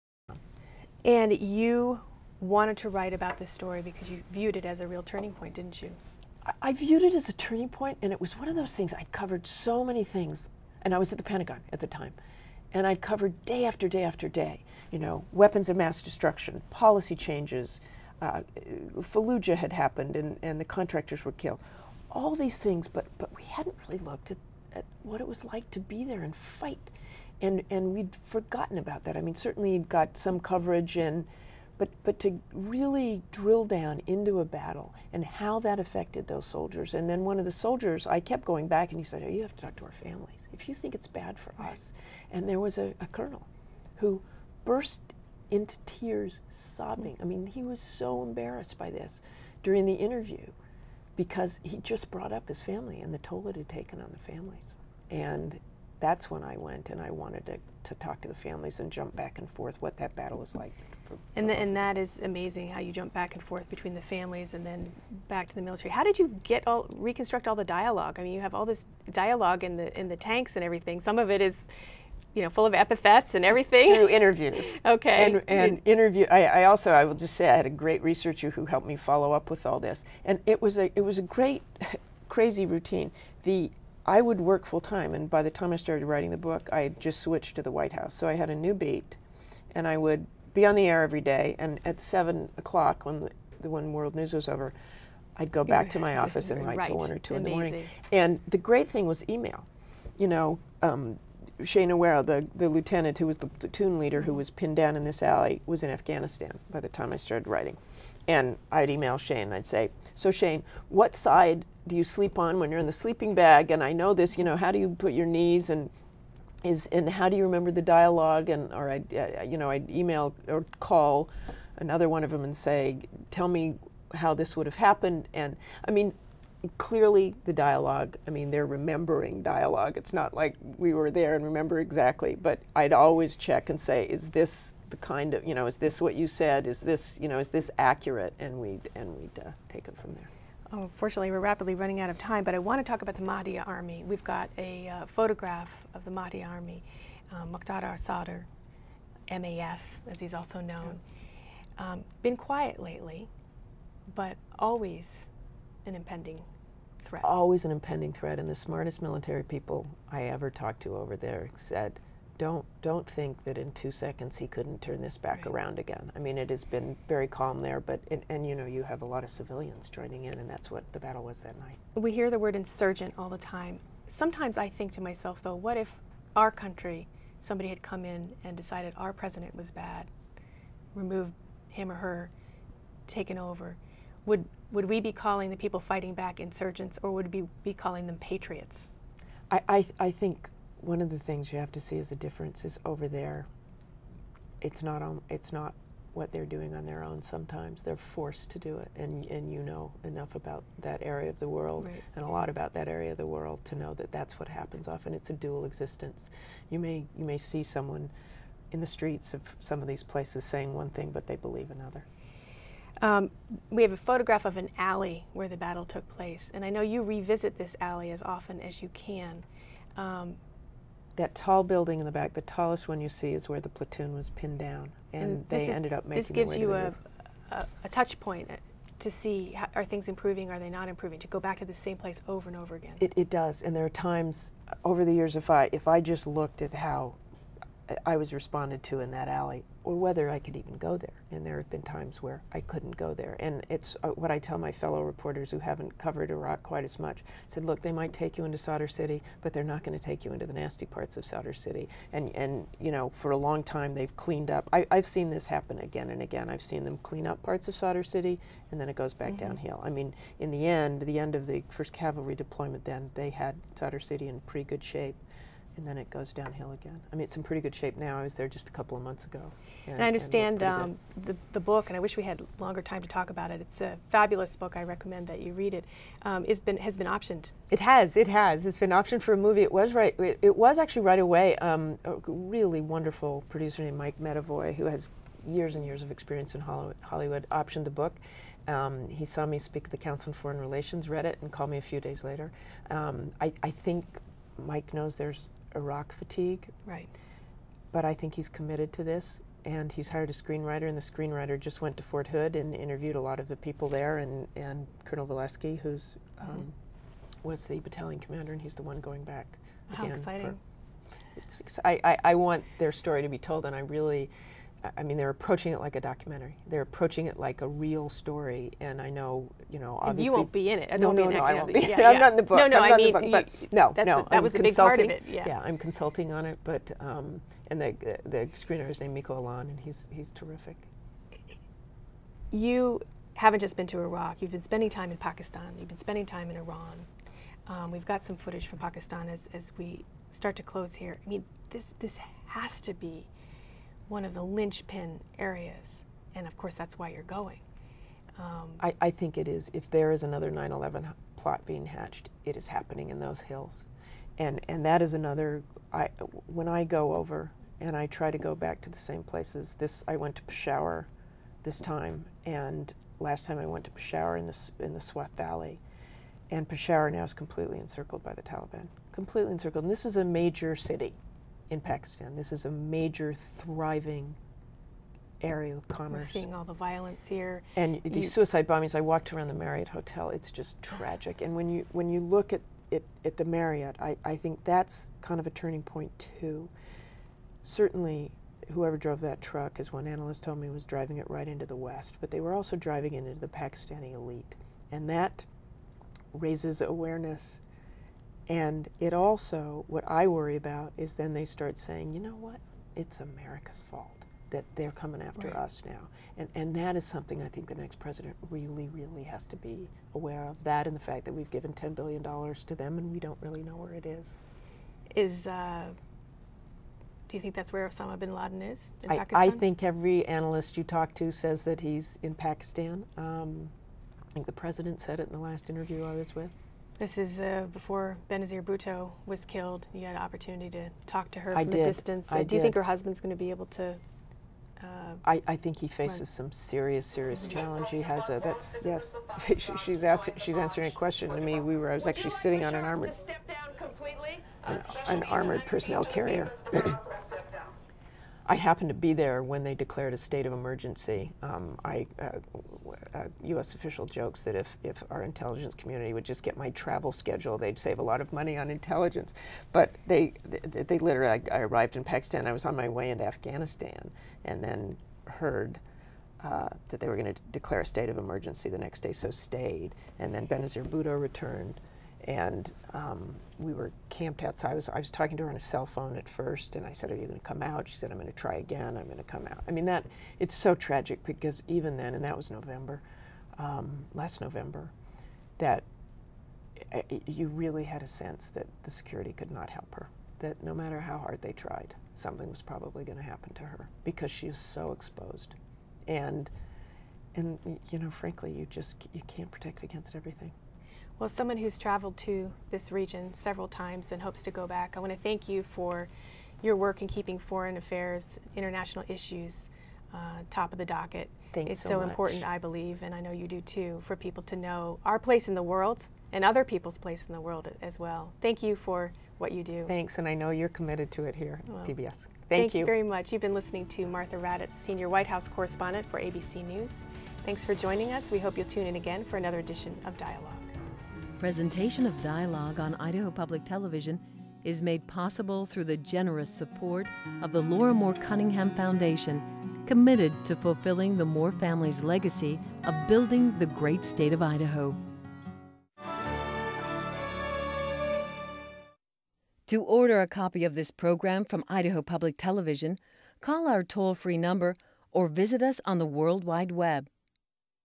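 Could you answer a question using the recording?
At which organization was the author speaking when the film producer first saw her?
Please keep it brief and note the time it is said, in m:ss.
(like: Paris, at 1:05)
Council on Foreign Relations, at 4:49.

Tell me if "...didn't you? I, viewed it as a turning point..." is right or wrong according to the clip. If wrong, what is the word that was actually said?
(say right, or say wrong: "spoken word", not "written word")
right.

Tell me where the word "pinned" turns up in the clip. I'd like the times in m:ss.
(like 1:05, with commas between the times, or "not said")
1:44, 3:44.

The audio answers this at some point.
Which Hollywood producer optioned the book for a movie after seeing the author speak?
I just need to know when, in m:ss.
4:43.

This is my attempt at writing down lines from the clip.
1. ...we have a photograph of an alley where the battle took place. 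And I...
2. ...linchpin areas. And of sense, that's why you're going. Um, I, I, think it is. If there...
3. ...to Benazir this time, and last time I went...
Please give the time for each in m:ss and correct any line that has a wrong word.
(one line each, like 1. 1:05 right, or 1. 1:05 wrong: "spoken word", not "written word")
1. 3:33 right
2. 5:44 wrong: "course", not "sense"
3. 6:00 wrong: "Peshawar", not "Benazir".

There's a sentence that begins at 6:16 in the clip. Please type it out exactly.
We're seeing all the violence here.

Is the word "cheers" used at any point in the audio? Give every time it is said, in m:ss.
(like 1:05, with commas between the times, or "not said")
not said.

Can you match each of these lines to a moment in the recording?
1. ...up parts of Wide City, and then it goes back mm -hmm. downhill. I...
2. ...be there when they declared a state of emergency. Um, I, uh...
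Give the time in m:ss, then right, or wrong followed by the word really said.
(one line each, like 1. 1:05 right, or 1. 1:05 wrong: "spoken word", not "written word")
1. 4:17 wrong: "Sadr", not "Wide"
2. 7:28 right.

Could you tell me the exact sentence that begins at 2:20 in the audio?
Oh, fortunately, we're rapidly running out of time, but I want to talk about the Mahdi army.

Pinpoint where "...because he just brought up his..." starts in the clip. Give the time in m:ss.
0:51.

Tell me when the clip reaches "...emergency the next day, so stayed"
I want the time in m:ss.
7:48.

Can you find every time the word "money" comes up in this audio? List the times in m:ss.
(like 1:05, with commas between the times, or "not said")
7:38.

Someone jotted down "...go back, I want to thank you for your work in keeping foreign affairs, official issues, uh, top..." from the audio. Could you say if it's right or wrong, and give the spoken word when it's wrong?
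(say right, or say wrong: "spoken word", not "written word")
wrong: "international", not "official".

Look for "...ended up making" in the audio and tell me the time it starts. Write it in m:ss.
3:45.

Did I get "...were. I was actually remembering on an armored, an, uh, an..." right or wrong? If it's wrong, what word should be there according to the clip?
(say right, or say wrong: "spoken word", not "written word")
wrong: "sitting", not "remembering".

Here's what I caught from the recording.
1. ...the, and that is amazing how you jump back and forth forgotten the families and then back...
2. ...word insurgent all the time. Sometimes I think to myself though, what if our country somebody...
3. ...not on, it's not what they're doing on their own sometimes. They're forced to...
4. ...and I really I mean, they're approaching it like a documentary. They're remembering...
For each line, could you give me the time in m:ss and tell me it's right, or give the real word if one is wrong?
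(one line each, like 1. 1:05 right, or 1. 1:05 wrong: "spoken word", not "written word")
1. 1:01 wrong: "between", not "forgotten"
2. 2:52 right
3. 3:14 right
4. 5:13 wrong: "approaching", not "remembering".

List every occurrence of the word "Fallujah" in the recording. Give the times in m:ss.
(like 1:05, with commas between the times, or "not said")
0:18.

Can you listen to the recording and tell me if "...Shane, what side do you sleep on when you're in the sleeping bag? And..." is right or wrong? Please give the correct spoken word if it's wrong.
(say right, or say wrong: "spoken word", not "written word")
right.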